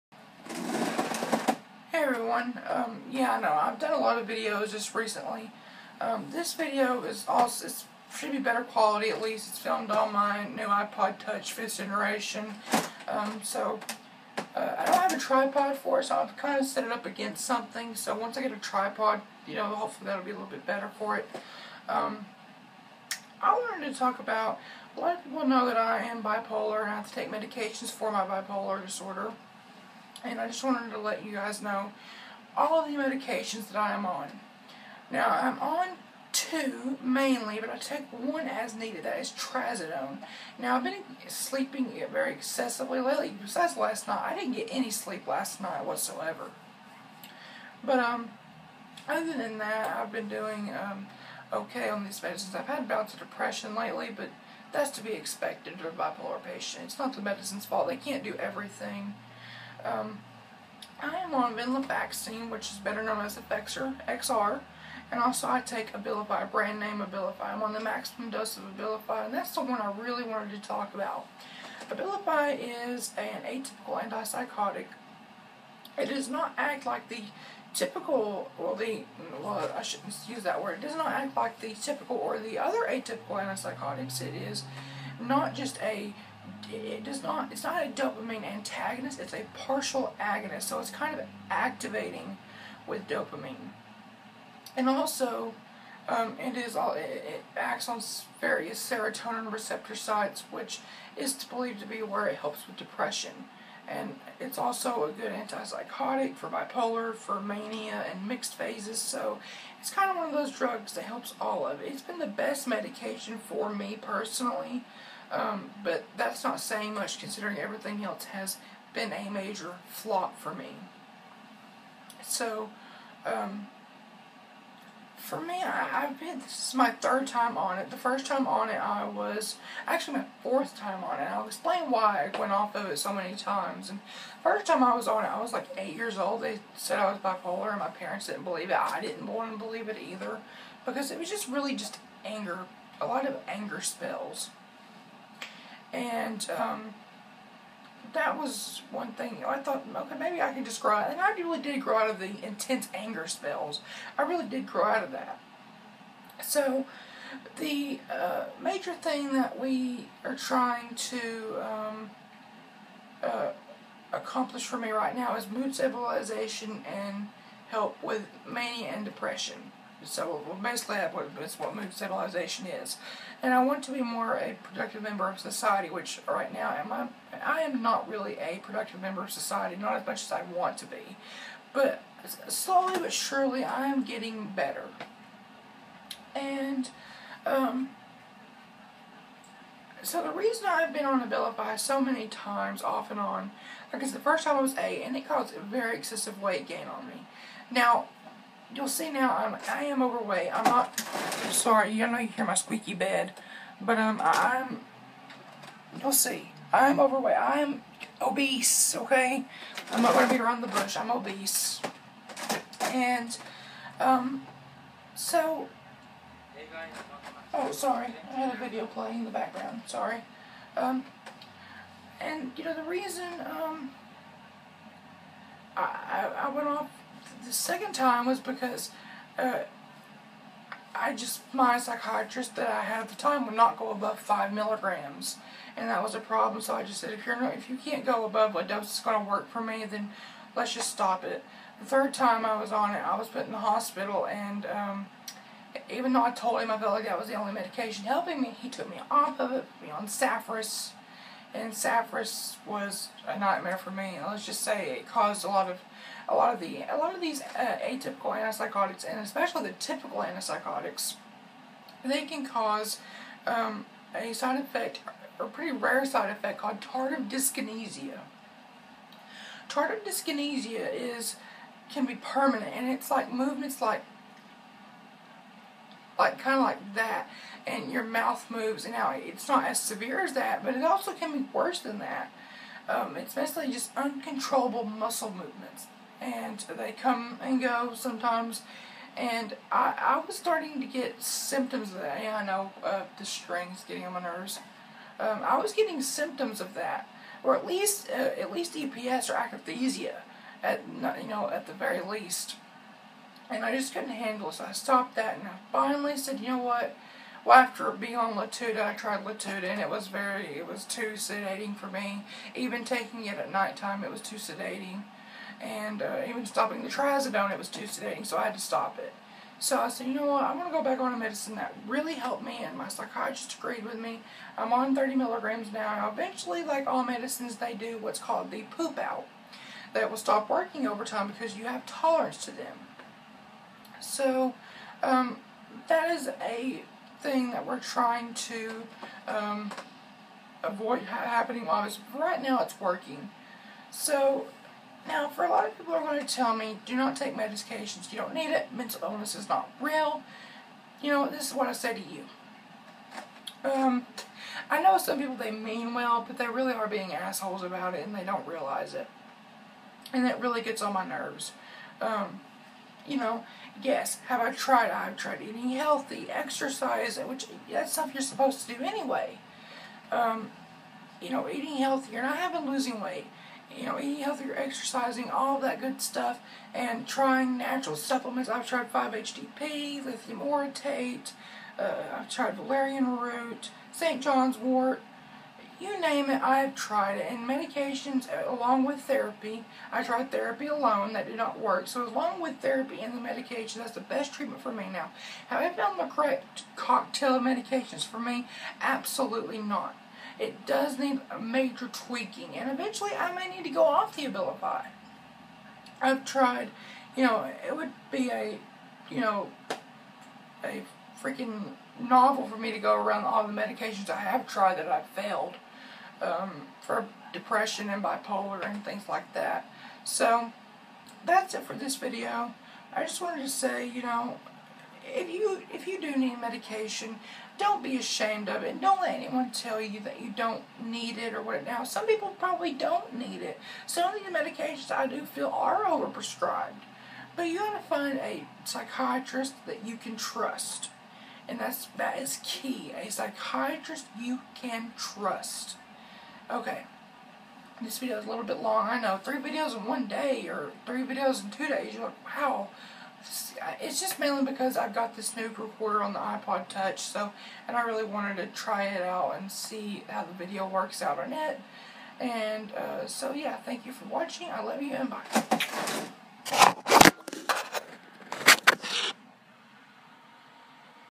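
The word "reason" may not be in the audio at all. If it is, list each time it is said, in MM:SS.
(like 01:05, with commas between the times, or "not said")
03:10, 03:42.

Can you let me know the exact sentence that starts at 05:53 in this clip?
Um, I know some people, they mean well, but they really are being assholes about it and they don't realize it.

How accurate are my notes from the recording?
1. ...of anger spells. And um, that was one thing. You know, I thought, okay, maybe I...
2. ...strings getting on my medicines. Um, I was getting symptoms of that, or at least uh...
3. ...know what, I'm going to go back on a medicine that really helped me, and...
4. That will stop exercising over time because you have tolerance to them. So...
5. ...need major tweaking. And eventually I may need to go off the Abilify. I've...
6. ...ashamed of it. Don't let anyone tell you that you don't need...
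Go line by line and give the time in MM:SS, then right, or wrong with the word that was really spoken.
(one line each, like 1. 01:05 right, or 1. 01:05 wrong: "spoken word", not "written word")
1. 02:23 right
2. 04:53 wrong: "nerves", not "medicines"
3. 05:20 right
4. 05:29 wrong: "working", not "exercising"
5. 06:40 right
6. 07:07 right.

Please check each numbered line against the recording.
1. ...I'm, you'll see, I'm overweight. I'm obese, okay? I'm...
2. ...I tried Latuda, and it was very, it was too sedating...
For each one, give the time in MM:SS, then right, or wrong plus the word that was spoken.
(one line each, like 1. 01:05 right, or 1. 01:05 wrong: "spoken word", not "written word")
1. 03:24 right
2. 05:08 right.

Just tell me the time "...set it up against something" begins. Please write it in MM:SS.
00:16.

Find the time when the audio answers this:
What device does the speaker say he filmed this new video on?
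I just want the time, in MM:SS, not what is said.
00:10.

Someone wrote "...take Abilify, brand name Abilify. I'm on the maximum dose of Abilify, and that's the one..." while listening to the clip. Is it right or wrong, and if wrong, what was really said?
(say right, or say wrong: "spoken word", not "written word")
right.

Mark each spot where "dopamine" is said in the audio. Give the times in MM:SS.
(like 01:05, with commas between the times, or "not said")
01:27, 01:33.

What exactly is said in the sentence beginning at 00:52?
I've had bouts of depression lately, but that's to be expected of a bipolar patient.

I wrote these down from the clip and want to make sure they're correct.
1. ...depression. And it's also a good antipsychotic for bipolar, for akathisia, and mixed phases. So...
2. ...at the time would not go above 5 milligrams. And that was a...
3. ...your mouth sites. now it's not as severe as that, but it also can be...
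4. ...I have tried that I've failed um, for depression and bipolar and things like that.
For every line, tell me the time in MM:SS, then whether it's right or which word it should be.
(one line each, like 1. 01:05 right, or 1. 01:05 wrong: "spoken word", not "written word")
1. 01:42 wrong: "mania", not "akathisia"
2. 03:53 right
3. 04:37 wrong: "moves", not "sites"
4. 06:54 right.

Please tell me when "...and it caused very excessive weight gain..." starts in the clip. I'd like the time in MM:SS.
03:15.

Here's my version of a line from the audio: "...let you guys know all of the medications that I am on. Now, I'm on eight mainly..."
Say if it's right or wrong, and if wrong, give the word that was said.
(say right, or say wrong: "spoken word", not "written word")
wrong: "two", not "eight".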